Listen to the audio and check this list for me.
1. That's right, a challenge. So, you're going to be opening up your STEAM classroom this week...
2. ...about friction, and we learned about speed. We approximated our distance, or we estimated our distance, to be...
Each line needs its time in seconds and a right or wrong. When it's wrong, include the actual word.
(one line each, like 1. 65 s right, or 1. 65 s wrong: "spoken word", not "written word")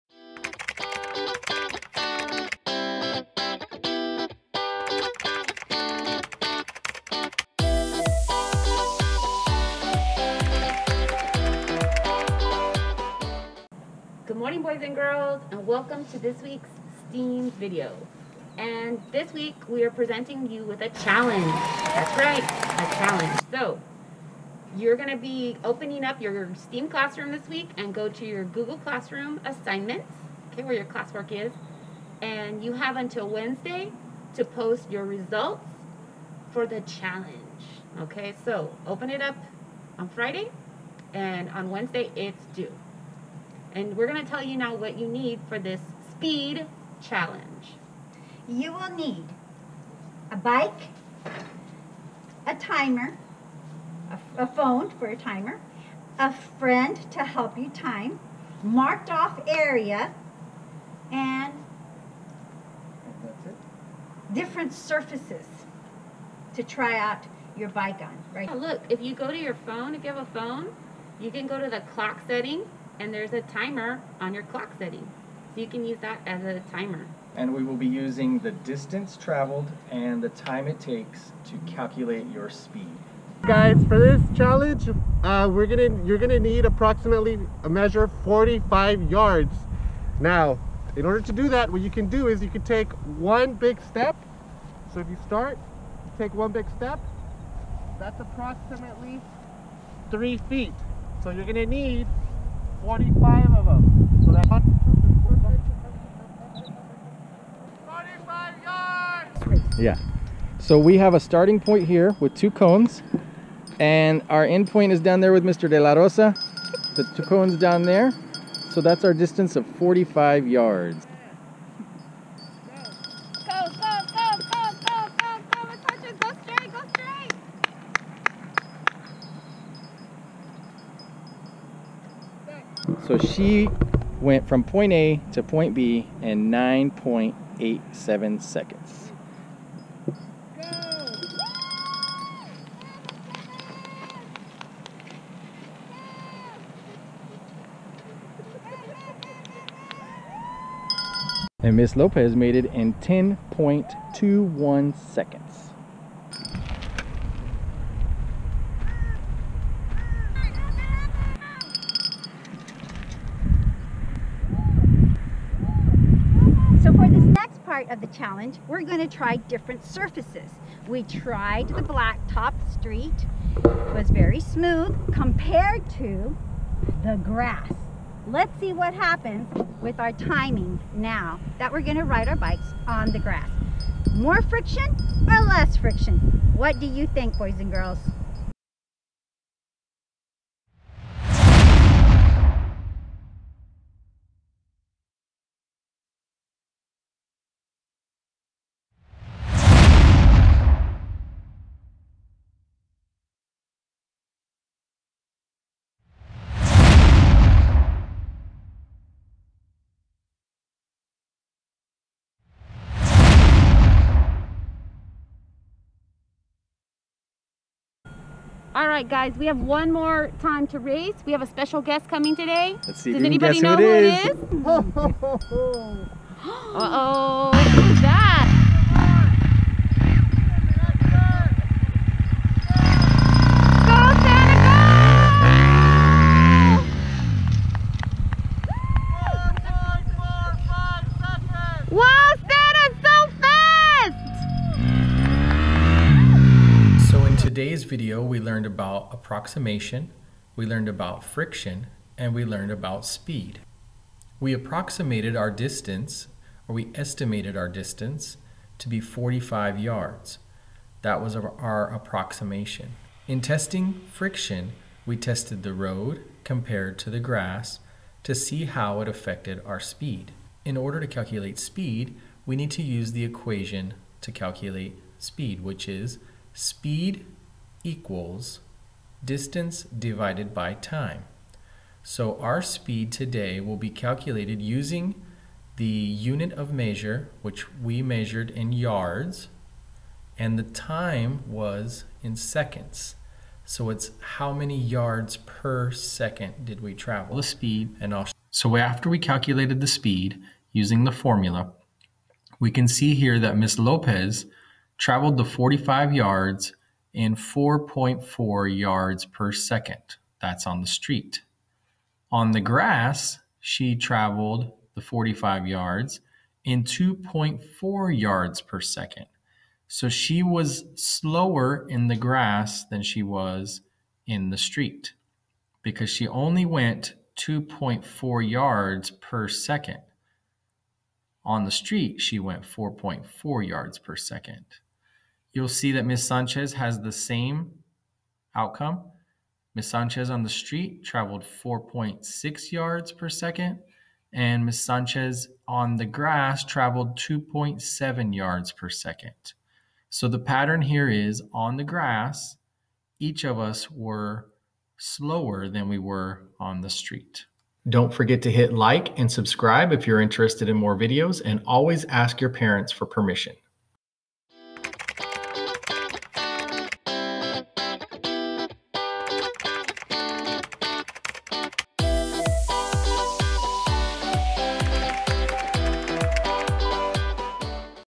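1. 21 s right
2. 250 s right.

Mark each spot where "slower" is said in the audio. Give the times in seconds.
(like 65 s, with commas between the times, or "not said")
320 s, 354 s.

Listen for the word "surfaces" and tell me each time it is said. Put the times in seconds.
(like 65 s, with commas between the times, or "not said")
64 s, 169 s.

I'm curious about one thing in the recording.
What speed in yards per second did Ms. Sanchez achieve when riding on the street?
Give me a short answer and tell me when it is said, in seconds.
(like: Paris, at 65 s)
4.6 yards per second, at 341 s.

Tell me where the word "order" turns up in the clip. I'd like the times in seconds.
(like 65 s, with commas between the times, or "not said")
91 s, 270 s.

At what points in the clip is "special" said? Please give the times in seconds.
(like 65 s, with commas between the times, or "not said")
221 s.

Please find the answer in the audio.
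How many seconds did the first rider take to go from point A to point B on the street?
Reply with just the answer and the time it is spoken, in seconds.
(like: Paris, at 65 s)
9.87 seconds, at 136 s.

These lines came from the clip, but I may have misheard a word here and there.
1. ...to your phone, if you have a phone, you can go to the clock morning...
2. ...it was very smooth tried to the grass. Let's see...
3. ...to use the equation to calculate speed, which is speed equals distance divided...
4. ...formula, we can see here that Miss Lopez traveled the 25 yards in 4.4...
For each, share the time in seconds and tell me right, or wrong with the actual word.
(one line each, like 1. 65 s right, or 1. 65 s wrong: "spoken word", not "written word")
1. 69 s wrong: "setting", not "morning"
2. 173 s wrong: "compared", not "tried"
3. 272 s right
4. 301 s wrong: "45", not "25".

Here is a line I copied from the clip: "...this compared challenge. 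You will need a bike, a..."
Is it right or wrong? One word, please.
wrong.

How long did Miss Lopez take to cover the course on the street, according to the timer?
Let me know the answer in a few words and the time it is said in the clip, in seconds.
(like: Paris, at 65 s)
10.21 seconds, at 152 s.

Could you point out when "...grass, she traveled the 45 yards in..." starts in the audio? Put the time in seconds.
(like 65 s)
312 s.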